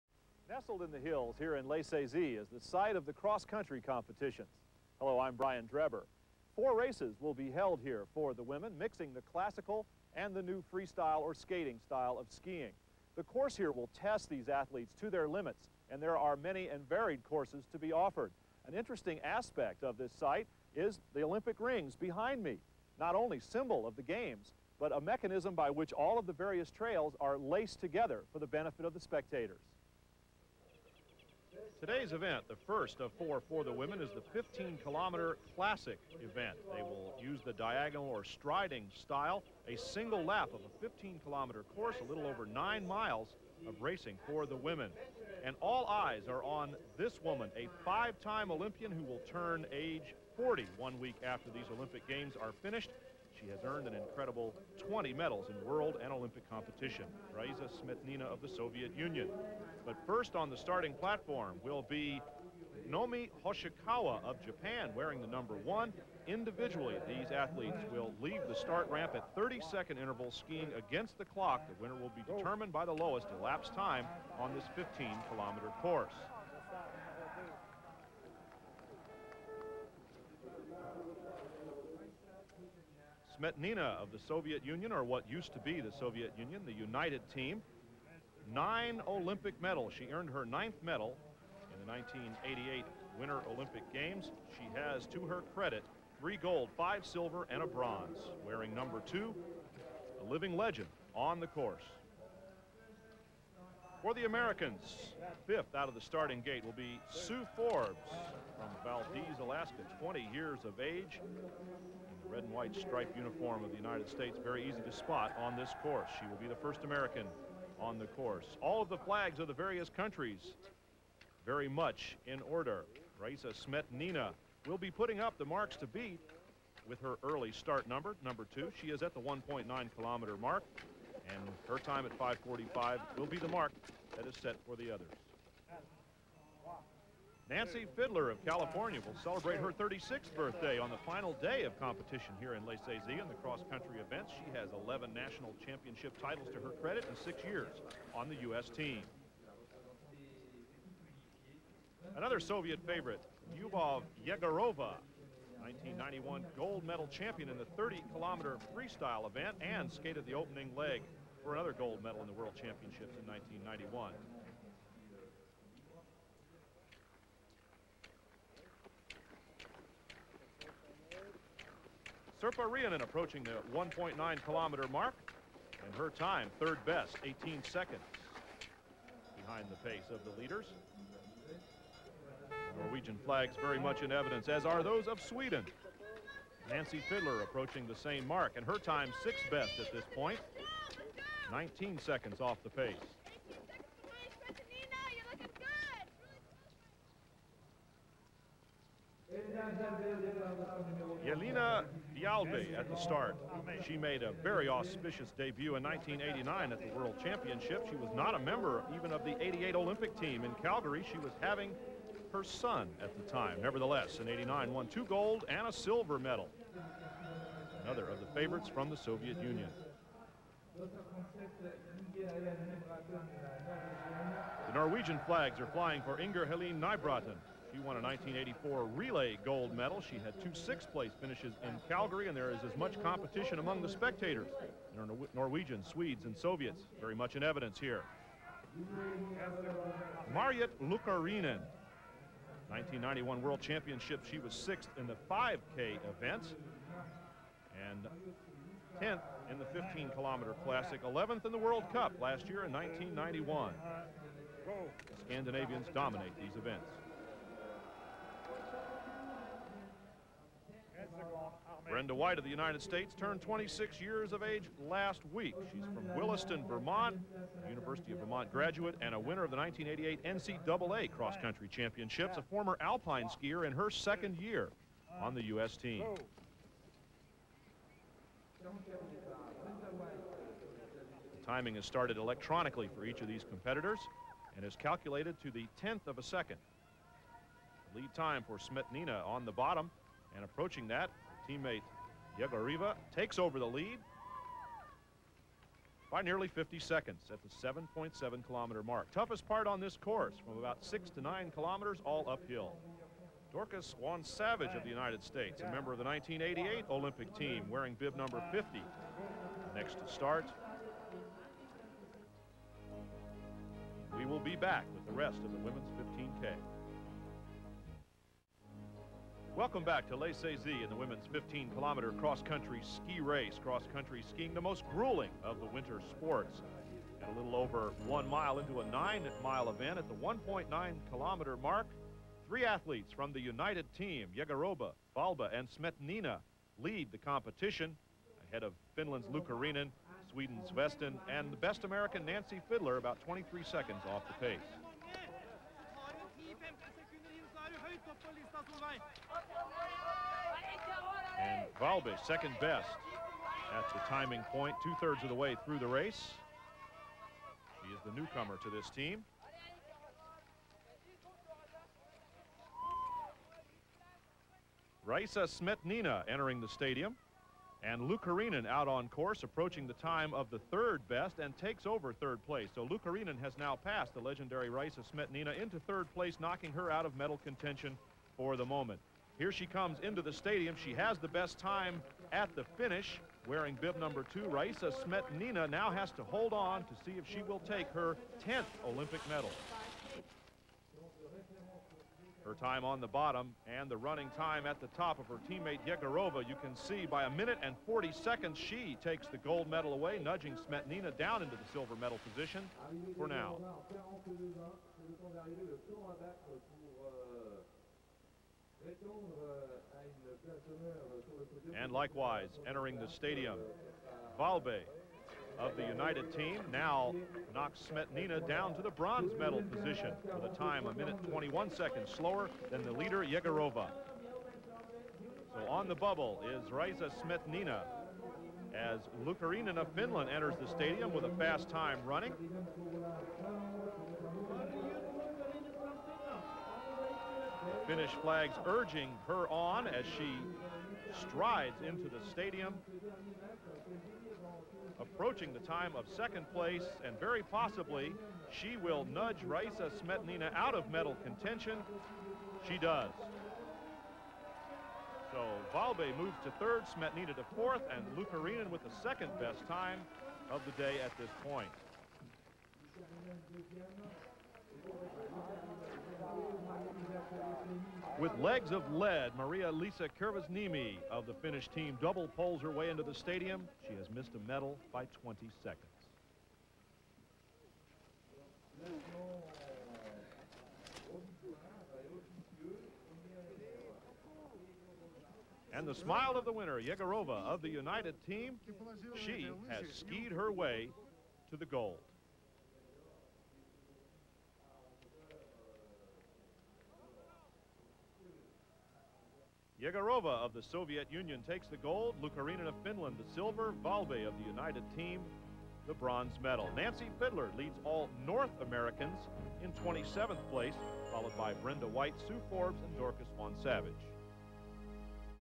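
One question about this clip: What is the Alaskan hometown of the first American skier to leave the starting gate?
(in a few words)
Valdez.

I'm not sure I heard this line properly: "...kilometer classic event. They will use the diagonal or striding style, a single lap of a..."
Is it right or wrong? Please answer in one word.
right.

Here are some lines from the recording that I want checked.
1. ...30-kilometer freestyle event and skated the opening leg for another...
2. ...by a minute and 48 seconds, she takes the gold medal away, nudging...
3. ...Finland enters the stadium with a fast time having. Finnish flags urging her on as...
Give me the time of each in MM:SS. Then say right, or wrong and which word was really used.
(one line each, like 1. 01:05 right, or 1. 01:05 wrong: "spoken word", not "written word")
1. 02:37 right
2. 06:37 wrong: "40", not "48"
3. 07:09 wrong: "running", not "having".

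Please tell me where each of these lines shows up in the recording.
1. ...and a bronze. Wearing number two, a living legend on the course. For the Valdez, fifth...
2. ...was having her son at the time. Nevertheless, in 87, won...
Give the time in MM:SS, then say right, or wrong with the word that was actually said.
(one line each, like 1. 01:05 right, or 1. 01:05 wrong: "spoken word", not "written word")
1. 01:37 wrong: "Americans", not "Valdez"
2. 03:31 wrong: "89", not "87".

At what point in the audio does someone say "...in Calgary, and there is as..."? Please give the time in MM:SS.
03:51.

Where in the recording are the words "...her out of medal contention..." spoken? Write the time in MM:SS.
06:16.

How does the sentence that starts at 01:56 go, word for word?
She will be the first American on the course.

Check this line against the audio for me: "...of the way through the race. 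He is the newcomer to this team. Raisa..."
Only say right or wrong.
right.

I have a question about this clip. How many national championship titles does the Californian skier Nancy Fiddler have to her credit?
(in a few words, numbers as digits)
11.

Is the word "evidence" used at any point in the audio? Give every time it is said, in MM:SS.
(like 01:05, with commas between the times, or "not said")
03:04, 03:57.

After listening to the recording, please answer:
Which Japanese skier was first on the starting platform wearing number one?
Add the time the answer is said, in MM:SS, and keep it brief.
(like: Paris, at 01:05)
Nomi Hoshikawa, at 01:02.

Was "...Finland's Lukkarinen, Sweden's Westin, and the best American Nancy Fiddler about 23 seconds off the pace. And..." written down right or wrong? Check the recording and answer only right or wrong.
right.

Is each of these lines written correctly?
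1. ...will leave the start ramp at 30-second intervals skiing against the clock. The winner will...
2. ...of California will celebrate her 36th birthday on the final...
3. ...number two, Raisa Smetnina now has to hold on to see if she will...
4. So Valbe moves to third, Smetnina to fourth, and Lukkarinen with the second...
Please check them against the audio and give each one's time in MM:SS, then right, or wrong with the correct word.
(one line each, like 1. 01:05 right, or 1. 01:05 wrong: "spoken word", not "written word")
1. 01:07 right
2. 02:18 right
3. 06:23 right
4. 07:35 right.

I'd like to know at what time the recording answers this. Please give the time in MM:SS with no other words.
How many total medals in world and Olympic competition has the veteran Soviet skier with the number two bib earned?
00:54.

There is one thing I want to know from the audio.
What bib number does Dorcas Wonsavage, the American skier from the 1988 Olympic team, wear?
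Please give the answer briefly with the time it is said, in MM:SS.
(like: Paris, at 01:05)
50, at 05:07.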